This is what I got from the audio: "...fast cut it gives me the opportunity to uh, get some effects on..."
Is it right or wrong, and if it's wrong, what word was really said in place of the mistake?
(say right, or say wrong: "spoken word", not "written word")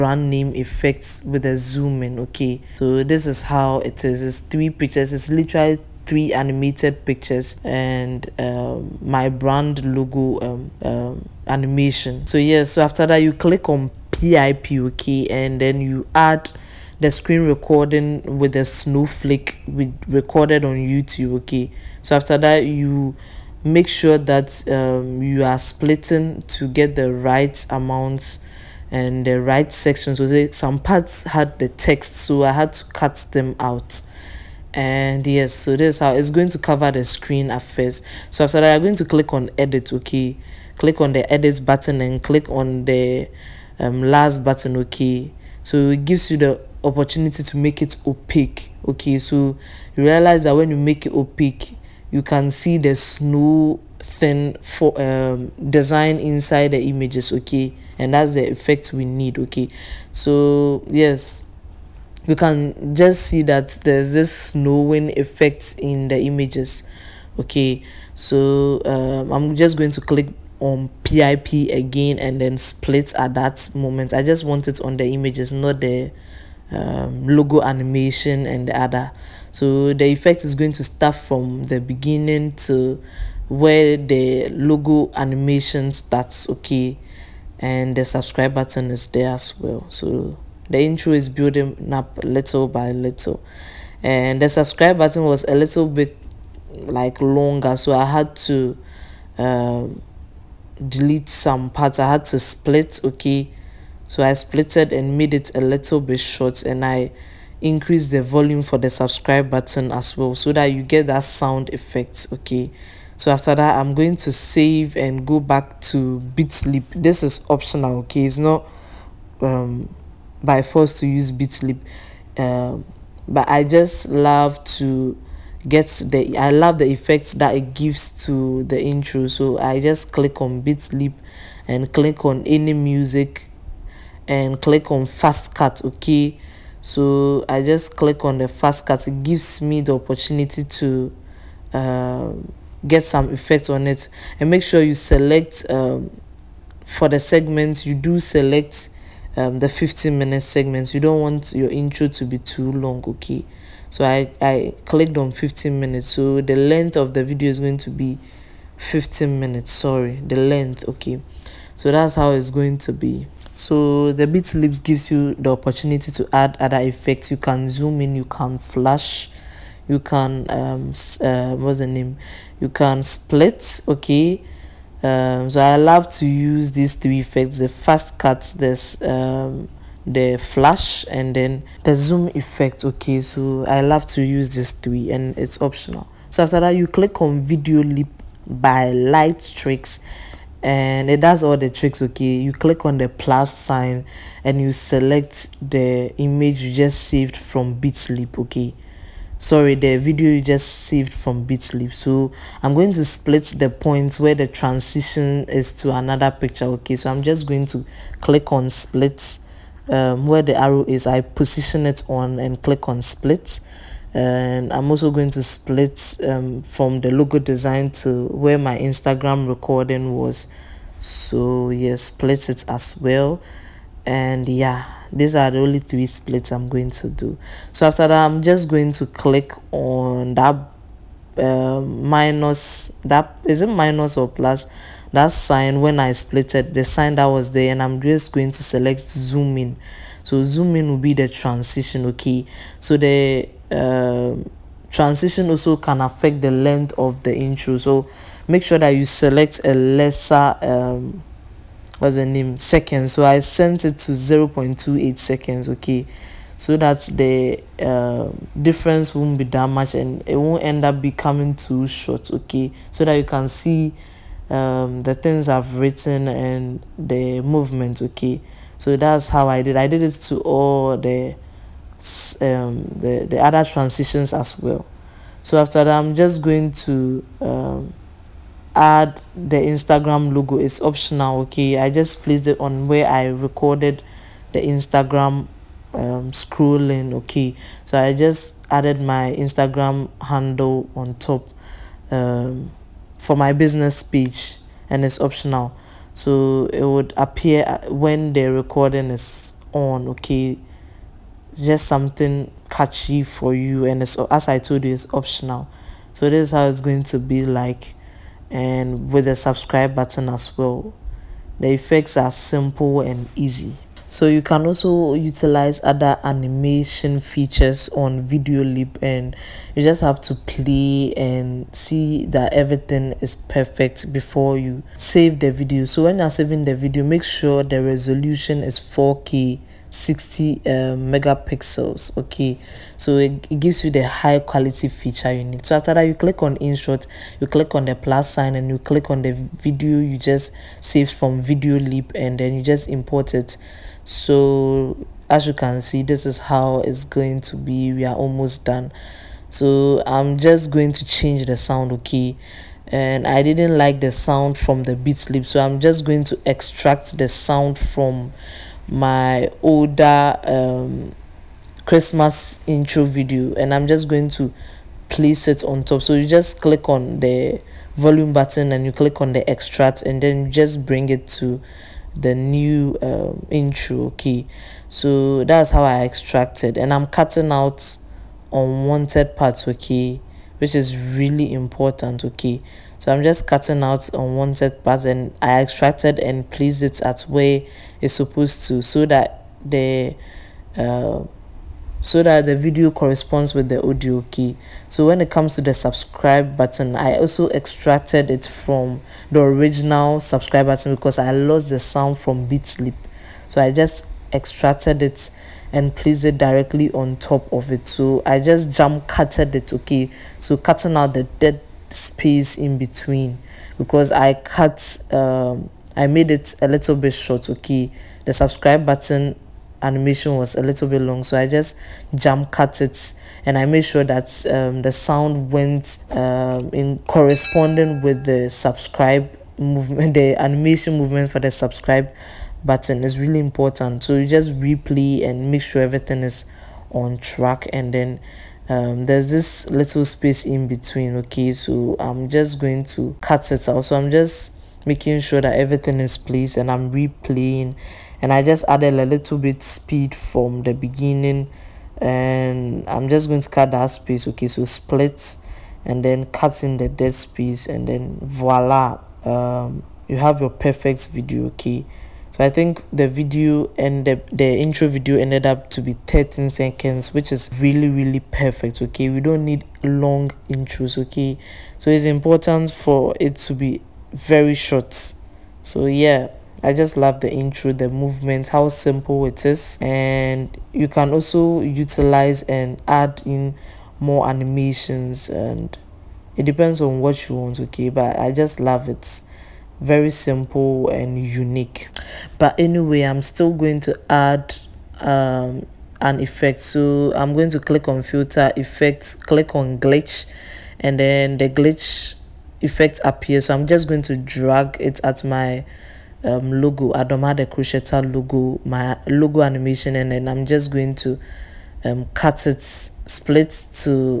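right.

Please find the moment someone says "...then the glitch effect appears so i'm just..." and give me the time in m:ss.
8:20.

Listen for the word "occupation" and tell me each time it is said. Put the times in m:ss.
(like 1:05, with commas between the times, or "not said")
not said.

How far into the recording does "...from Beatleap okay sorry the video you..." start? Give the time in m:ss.
3:17.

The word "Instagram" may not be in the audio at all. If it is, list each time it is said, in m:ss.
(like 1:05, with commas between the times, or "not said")
3:38, 4:39, 4:44, 4:49.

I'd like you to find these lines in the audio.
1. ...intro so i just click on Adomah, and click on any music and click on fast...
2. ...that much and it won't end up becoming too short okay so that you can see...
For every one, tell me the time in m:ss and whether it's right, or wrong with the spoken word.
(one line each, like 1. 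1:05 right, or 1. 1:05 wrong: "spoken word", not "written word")
1. 2:08 wrong: "Beatleap", not "Adomah"
2. 4:19 right.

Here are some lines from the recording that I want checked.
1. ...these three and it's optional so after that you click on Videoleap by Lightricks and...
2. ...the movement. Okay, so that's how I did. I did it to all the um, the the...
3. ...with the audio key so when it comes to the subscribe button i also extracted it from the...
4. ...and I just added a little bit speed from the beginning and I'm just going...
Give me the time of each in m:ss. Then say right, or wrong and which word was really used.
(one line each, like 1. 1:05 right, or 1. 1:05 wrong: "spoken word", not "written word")
1. 3:04 right
2. 4:26 right
3. 6:33 right
4. 7:28 right.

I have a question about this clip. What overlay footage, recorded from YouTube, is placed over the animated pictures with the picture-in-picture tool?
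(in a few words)
A snowflake.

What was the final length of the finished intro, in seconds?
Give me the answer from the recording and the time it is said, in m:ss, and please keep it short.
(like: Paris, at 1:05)
13 seconds, at 7:46.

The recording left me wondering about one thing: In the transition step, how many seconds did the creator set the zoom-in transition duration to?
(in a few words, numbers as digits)
0.28 seconds.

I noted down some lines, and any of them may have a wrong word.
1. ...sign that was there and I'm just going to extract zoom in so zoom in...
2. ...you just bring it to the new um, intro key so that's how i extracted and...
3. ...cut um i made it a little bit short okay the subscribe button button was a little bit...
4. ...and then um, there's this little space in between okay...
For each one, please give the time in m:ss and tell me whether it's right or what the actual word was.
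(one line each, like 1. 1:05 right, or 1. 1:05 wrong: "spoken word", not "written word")
1. 3:56 wrong: "select", not "extract"
2. 6:10 right
3. 6:54 wrong: "animation", not "button"
4. 7:17 right.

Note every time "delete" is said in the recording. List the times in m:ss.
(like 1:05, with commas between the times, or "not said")
1:40.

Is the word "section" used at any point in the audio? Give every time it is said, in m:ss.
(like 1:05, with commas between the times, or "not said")
0:29.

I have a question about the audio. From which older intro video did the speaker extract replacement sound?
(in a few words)
Christmas intro.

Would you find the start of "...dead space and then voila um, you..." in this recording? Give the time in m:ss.
7:36.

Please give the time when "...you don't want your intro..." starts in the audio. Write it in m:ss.
2:30.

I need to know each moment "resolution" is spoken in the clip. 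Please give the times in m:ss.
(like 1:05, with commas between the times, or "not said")
5:27.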